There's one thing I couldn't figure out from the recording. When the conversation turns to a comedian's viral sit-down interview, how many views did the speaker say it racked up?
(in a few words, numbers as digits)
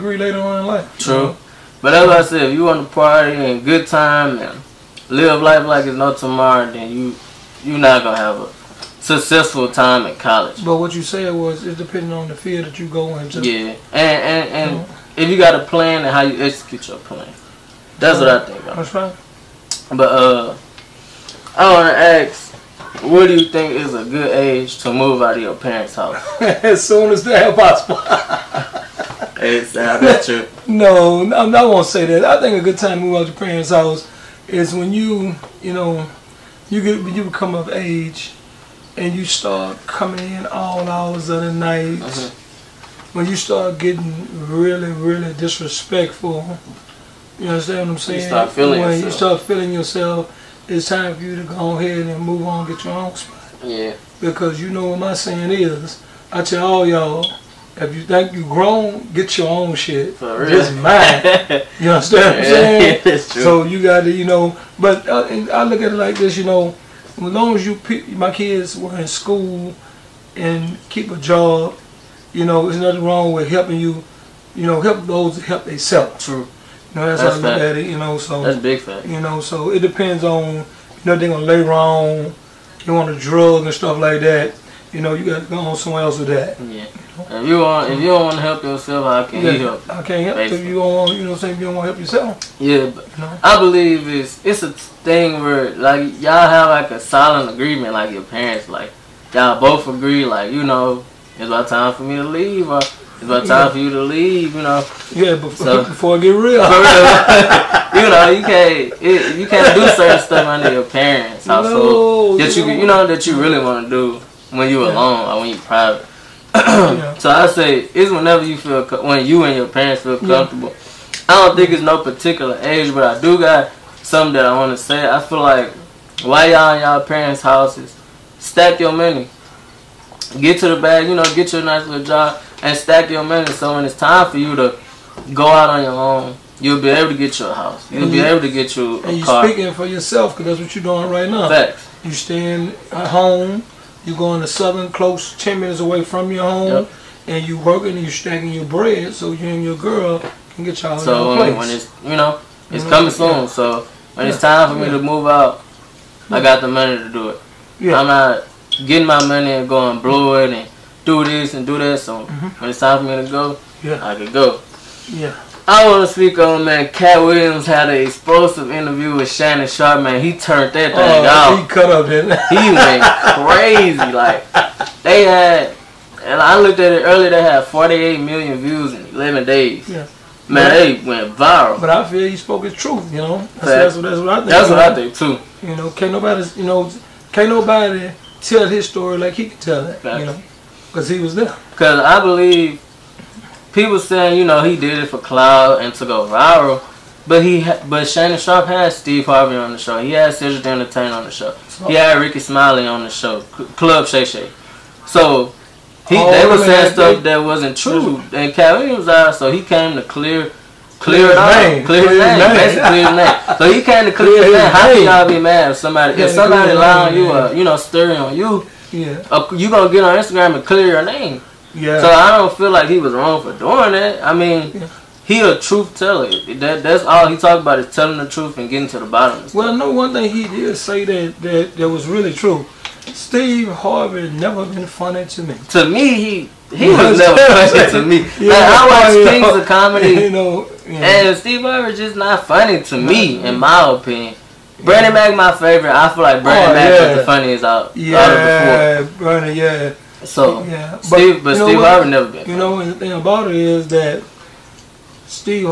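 48 million.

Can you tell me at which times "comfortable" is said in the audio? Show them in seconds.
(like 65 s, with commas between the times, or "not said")
120 s.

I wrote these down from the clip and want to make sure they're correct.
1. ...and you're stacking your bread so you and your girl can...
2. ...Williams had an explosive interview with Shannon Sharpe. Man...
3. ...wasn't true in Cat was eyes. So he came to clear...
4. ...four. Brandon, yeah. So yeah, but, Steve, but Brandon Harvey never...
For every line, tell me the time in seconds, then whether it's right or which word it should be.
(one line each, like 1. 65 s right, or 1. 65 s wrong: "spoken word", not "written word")
1. 147 s right
2. 167 s right
3. 207 s right
4. 249 s wrong: "Steve", not "Brandon".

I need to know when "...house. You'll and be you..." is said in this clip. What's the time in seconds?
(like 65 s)
137 s.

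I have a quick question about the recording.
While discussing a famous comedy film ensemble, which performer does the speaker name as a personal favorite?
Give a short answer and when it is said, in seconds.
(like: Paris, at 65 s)
Bernie Mac, at 244 s.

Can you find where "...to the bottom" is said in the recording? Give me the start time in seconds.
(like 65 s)
228 s.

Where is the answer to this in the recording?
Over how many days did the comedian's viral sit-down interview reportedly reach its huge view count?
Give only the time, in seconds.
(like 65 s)
179 s.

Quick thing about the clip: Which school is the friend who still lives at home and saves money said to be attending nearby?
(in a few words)
Southern.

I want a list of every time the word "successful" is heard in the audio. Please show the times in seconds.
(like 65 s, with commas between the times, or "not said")
9 s.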